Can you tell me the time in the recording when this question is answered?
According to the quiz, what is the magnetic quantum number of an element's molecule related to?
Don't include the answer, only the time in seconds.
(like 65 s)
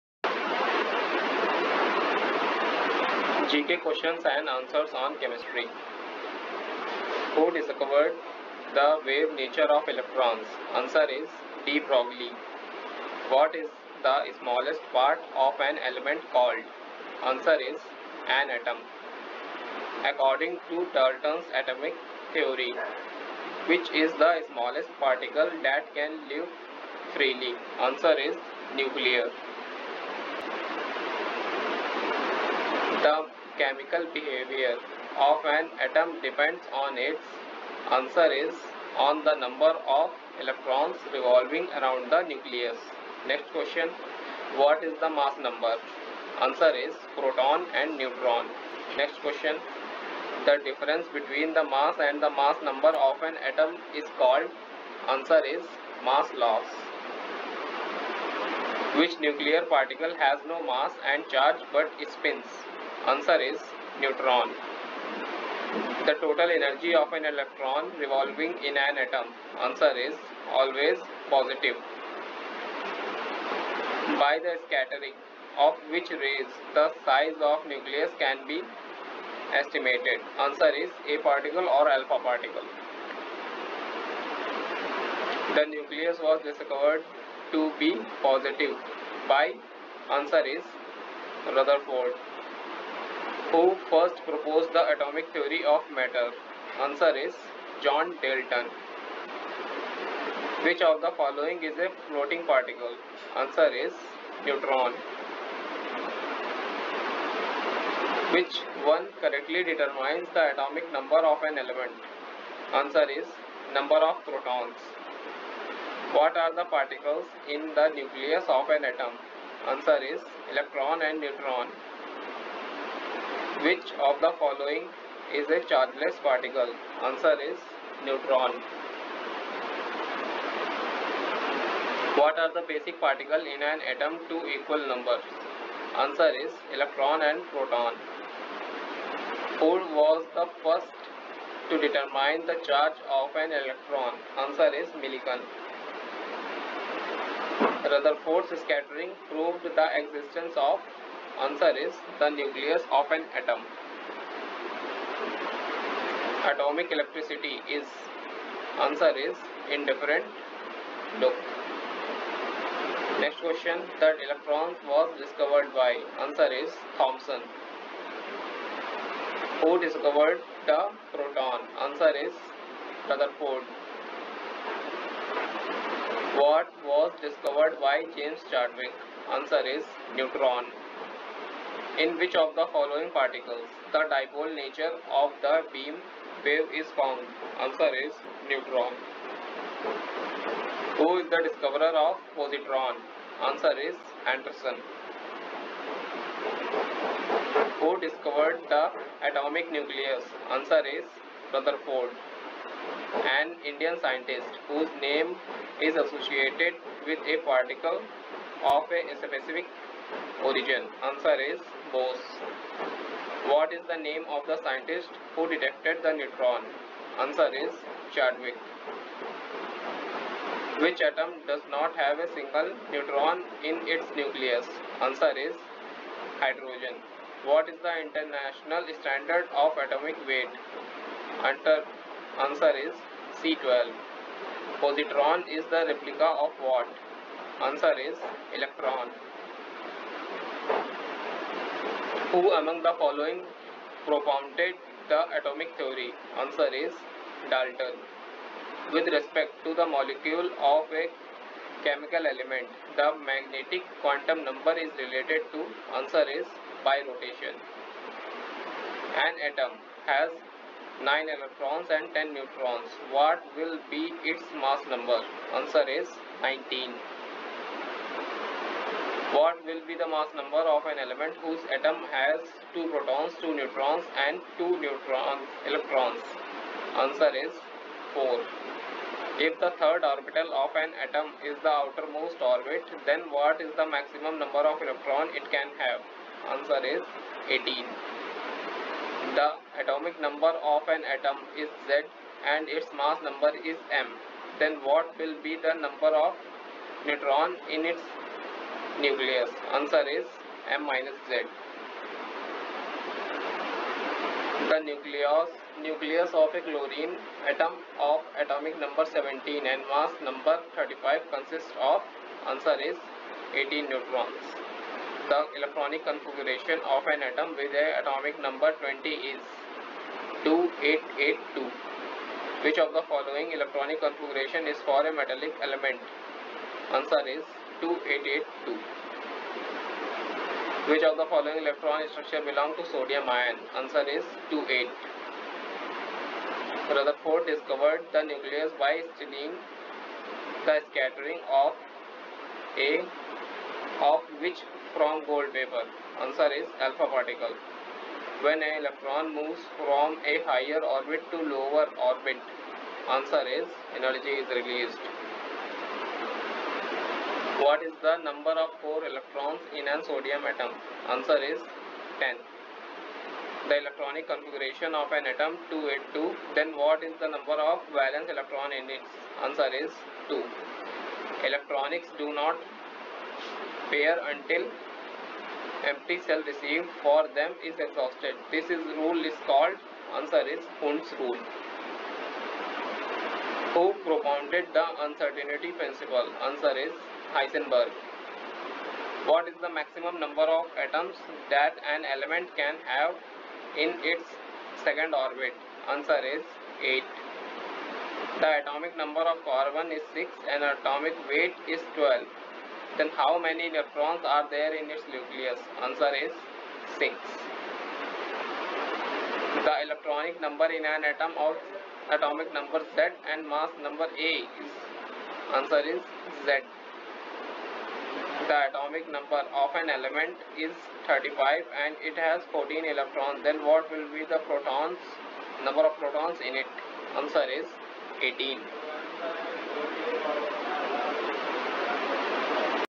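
256 s.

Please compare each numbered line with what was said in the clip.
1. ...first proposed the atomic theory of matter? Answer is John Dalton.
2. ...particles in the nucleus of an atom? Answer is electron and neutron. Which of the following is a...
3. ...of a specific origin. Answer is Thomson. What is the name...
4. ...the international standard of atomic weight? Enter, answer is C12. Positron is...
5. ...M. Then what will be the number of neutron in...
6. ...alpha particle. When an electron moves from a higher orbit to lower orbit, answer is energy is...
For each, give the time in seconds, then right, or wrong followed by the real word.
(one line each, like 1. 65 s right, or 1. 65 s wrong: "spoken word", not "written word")
1. 93 s right
2. 116 s right
3. 208 s wrong: "Bose", not "Thomson"
4. 227 s right
5. 293 s right
6. 346 s right.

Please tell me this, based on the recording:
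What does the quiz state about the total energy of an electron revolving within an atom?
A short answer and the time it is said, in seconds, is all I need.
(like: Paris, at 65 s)
Always positive, at 70 s.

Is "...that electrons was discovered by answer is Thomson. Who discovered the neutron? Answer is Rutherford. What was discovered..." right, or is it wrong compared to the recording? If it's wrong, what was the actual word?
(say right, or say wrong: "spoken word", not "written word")
wrong: "proton", not "neutron".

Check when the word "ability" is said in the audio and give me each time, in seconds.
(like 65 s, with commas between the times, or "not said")
not said.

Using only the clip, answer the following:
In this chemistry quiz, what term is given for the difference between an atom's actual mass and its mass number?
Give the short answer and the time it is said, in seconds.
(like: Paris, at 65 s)
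Mass loss, at 56 s.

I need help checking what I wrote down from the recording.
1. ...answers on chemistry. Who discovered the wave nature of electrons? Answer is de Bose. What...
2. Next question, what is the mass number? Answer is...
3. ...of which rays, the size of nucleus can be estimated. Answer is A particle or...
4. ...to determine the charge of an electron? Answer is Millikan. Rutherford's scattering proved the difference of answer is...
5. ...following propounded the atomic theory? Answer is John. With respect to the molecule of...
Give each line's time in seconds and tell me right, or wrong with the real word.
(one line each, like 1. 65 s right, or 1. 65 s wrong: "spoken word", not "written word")
1. 4 s wrong: "Broglie", not "Bose"
2. 43 s right
3. 75 s right
4. 141 s wrong: "existence", not "difference"
5. 242 s wrong: "Dalton", not "John".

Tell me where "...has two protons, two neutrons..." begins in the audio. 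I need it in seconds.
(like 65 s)
272 s.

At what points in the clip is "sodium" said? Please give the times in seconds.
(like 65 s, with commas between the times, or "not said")
332 s, 360 s.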